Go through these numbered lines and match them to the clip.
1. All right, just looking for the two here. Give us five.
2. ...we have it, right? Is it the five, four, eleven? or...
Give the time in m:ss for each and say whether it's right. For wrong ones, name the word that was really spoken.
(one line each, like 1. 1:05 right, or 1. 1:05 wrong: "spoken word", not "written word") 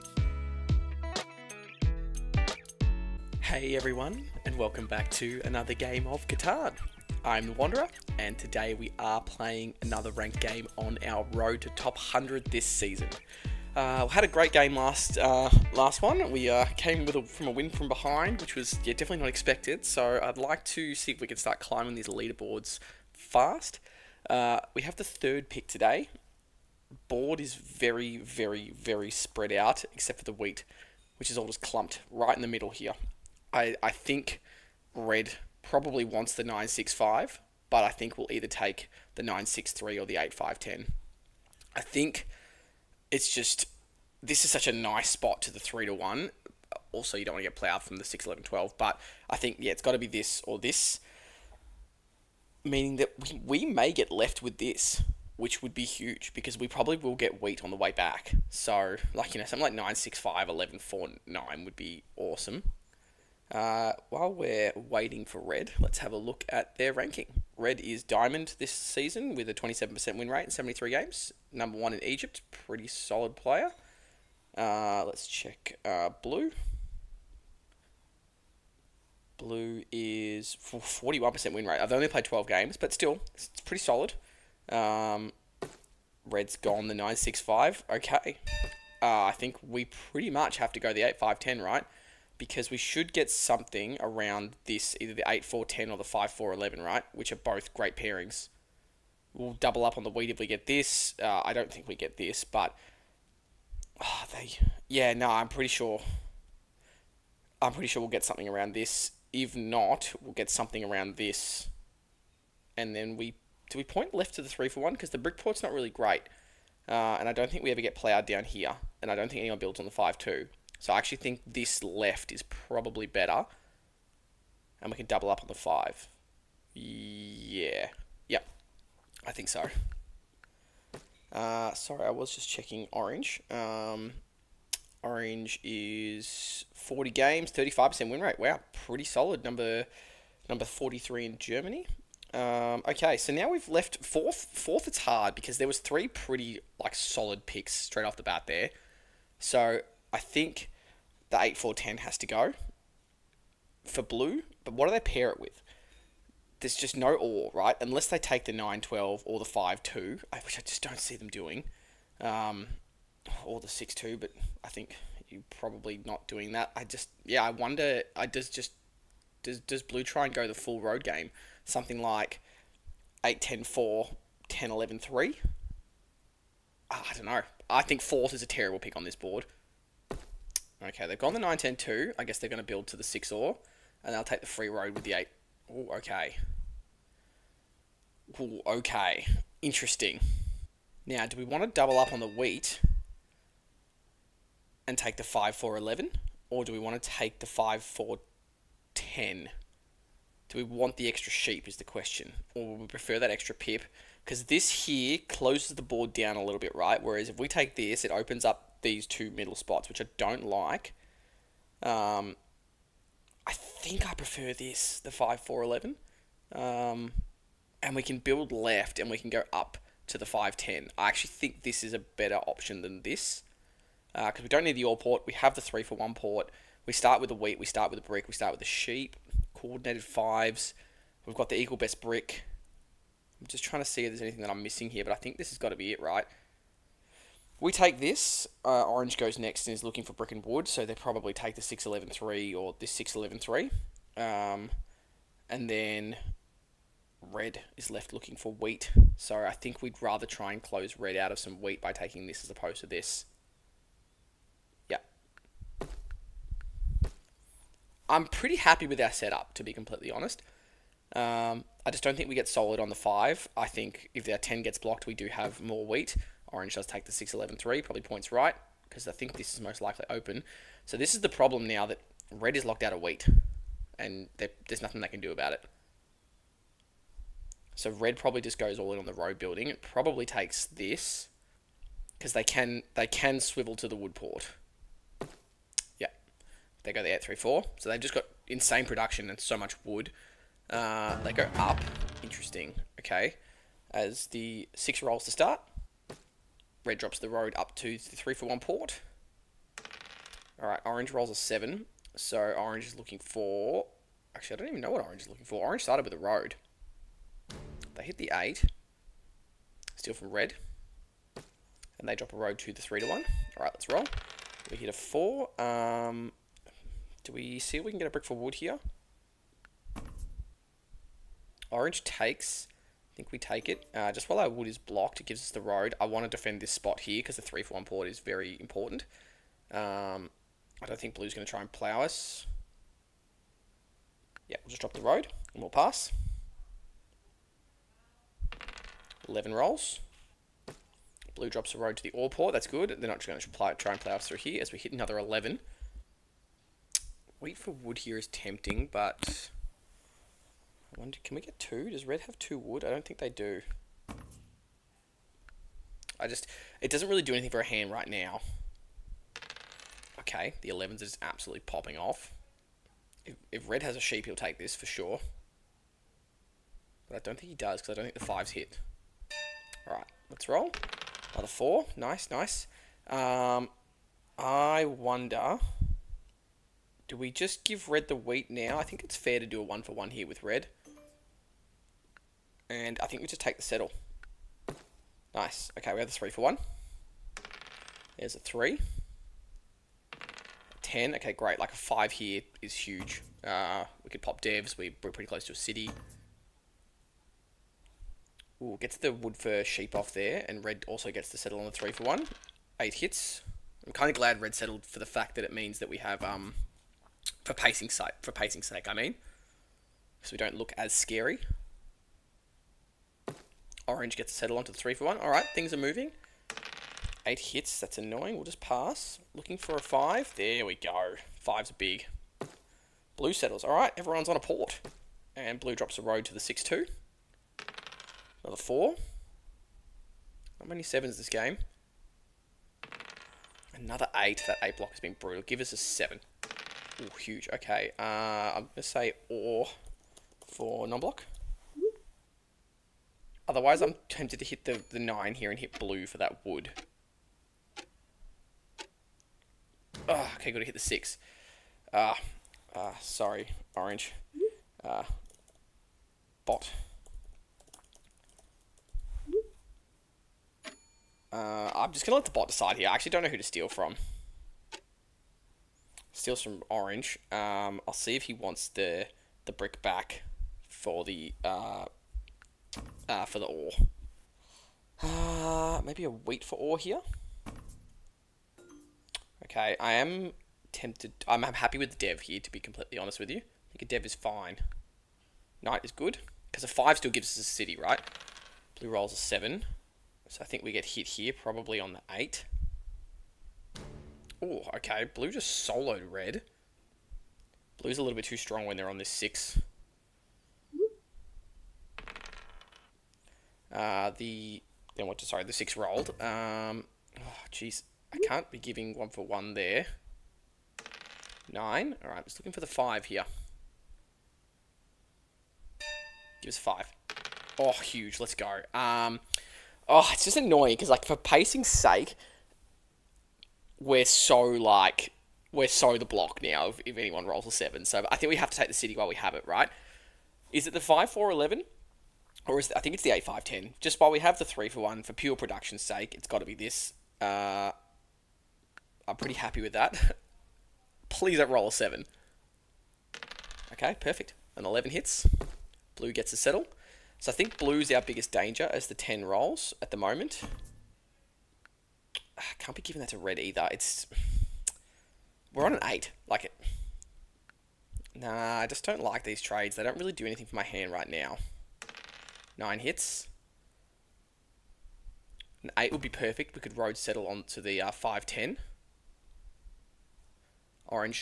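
1. 8:32 wrong: "five", not "two"
2. 8:49 right.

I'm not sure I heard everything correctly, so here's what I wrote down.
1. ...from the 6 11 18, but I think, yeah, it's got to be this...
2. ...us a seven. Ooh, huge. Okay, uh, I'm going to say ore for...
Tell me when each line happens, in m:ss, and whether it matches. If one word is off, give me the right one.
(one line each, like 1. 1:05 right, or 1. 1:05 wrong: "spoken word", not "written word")
1. 0:47 wrong: "12", not "18"
2. 7:15 right.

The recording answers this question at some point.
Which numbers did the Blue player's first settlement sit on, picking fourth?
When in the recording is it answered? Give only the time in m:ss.
3:01.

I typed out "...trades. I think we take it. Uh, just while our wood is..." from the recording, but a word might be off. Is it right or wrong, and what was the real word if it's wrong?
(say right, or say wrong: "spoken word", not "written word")
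wrong: "takes", not "trades".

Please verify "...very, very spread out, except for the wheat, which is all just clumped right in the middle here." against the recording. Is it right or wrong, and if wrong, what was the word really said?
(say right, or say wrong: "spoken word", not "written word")
right.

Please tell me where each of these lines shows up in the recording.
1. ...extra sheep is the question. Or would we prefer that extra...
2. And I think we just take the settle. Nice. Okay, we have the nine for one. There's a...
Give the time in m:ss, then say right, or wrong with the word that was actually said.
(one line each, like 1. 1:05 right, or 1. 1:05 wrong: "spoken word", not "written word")
1. 3:21 right
2. 6:22 wrong: "three", not "nine".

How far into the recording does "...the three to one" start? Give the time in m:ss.
5:12.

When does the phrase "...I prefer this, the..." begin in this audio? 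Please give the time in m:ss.
3:34.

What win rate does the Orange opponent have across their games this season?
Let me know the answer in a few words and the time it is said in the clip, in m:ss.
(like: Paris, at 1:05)
35%, at 2:17.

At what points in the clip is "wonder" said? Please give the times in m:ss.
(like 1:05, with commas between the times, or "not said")
2:47, 5:50, 6:14.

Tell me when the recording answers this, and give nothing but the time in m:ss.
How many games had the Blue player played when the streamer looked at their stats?
1:22.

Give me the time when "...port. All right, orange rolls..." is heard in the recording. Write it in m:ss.
4:58.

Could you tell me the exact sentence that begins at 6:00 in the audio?
Okay, the 11s is absolutely popping off.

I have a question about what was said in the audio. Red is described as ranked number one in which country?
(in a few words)
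Egypt.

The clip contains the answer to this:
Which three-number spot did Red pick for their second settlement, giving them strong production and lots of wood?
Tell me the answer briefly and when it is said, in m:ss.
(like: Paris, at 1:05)
8 3 4, at 4:47.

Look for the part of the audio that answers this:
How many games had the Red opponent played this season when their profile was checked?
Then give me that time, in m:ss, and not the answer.
1:10.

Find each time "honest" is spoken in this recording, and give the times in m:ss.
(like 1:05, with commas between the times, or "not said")
4:20, 8:02.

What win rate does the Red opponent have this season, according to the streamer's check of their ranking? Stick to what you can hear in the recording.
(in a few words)
27%.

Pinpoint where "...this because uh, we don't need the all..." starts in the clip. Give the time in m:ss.
3:43.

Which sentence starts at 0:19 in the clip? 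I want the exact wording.
So I'd like to see if we can start climbing these leaderboards fast.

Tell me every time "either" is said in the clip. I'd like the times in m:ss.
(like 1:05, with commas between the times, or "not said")
0:38, 1:34, 9:13.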